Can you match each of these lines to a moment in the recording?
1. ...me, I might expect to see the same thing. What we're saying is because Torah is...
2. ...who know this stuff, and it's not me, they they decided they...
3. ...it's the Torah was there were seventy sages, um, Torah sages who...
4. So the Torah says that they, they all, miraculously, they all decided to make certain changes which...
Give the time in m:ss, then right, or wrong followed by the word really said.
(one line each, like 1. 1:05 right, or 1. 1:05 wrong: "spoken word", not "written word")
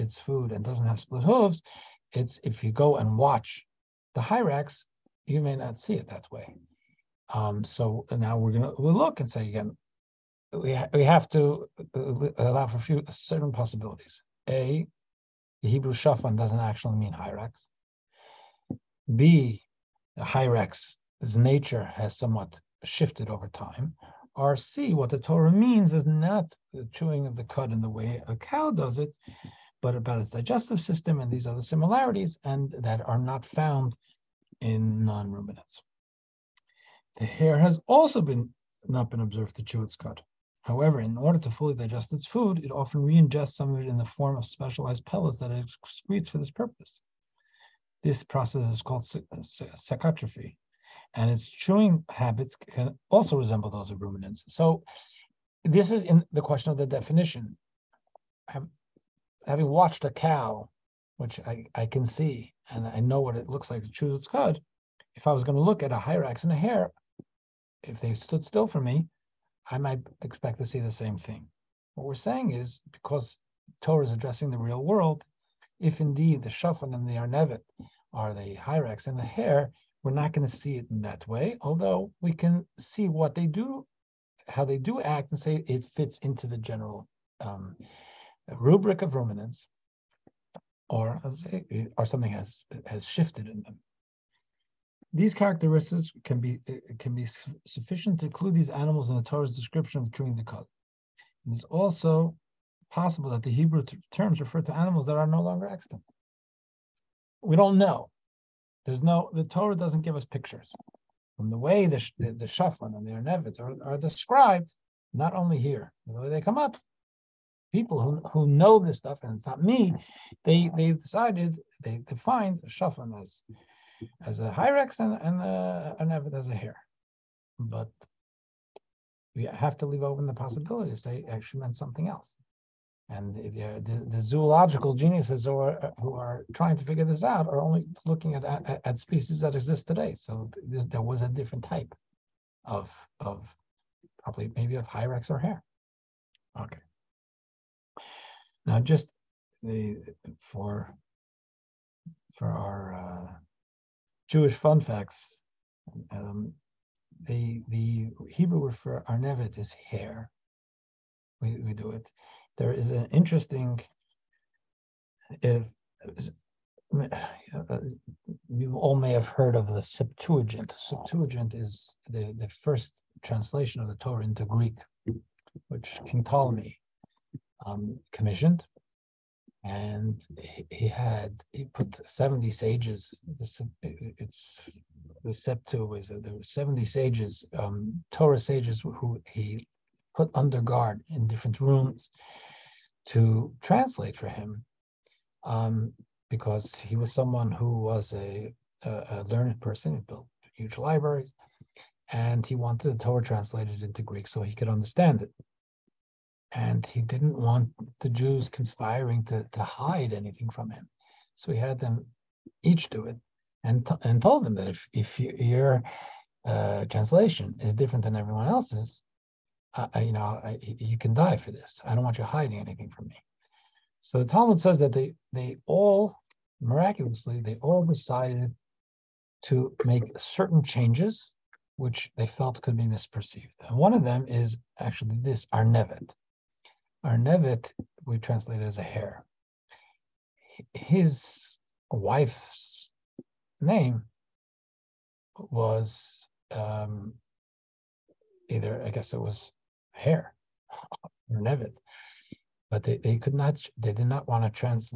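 1. 1:08 right
2. 1:58 right
3. 3:03 wrong: "Septu", not "Torah"
4. 3:44 wrong: "Talmud", not "Torah".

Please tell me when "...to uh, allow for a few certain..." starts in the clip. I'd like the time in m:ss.
0:11.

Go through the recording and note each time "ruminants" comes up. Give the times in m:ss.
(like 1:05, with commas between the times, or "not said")
0:35, 0:54, 1:29.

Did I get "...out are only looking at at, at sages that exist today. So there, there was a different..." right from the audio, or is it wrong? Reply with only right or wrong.
wrong.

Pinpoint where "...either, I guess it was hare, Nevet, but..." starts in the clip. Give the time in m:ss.
4:08.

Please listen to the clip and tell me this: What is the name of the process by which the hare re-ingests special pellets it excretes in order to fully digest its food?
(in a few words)
Cecotrophy.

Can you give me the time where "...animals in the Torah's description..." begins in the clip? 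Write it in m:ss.
1:38.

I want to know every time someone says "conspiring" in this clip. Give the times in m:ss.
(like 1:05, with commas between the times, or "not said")
3:28.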